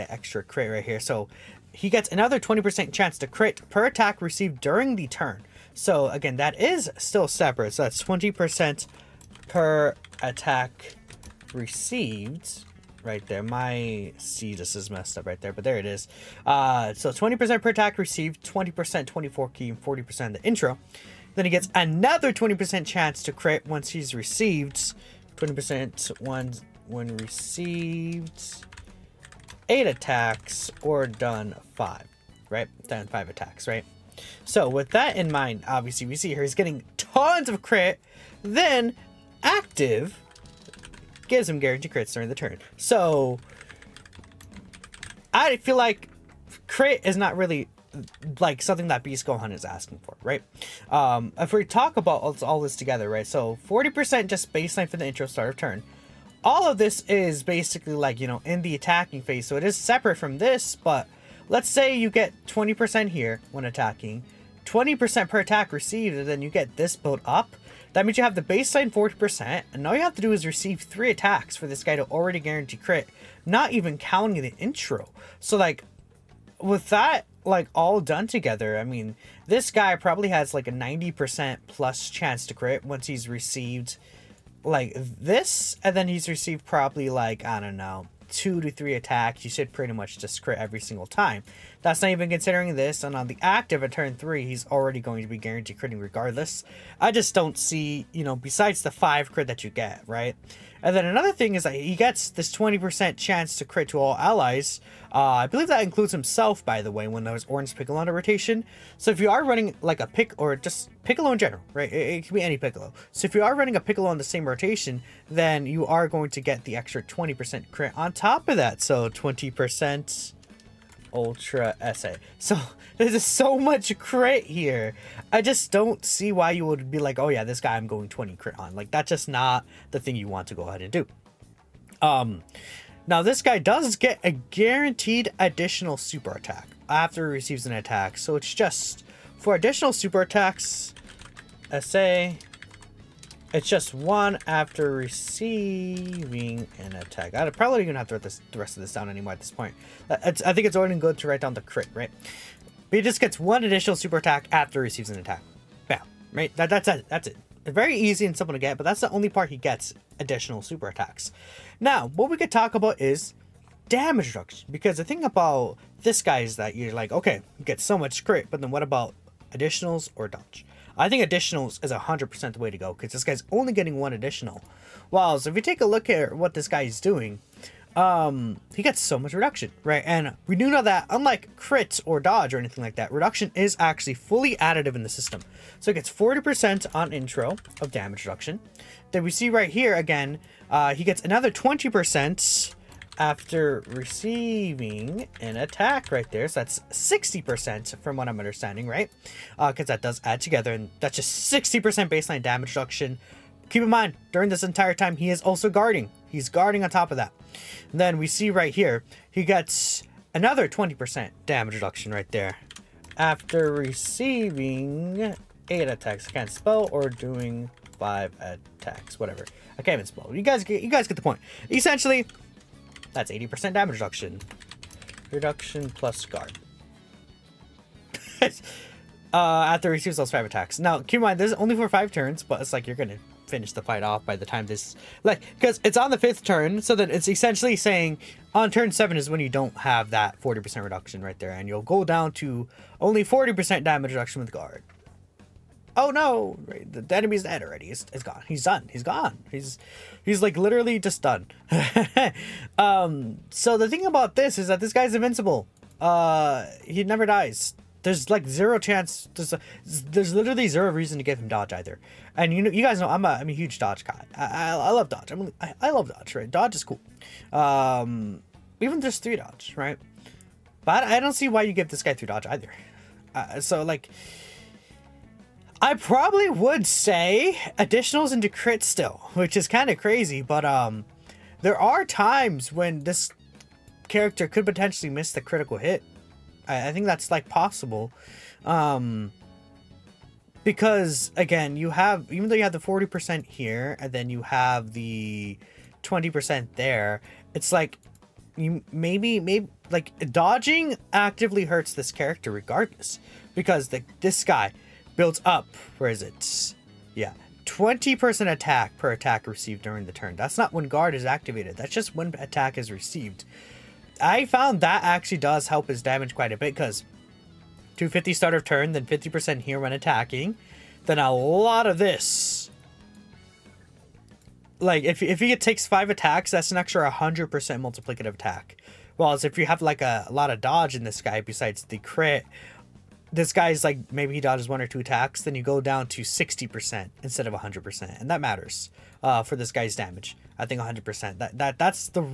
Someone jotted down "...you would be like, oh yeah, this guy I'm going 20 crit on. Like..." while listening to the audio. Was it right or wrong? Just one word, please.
right.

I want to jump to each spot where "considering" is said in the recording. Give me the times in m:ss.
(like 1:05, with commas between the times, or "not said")
1:32.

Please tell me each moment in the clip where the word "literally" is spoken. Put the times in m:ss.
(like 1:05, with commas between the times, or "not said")
4:10, 4:20.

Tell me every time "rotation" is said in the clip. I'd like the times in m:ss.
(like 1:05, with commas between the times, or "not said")
1:48, 1:54.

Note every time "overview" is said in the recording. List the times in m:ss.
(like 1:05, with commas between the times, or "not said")
not said.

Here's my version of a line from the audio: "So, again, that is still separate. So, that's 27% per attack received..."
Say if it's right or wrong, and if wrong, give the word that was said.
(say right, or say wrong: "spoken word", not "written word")
wrong: "20", not "27".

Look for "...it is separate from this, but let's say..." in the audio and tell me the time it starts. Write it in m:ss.
0:59.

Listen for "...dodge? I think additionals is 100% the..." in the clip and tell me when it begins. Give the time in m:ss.
2:50.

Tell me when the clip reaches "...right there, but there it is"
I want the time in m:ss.
0:15.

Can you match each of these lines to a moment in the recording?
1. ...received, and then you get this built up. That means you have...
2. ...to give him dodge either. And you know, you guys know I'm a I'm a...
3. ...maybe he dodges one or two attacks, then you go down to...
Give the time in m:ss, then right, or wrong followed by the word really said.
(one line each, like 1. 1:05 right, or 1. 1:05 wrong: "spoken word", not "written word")
1. 1:05 right
2. 4:21 right
3. 5:34 right.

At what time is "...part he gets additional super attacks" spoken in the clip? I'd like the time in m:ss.
2:39.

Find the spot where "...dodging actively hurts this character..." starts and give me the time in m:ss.
5:00.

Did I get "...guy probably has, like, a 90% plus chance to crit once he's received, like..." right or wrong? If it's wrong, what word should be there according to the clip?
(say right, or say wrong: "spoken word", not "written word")
right.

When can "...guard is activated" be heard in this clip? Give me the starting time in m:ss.
5:10.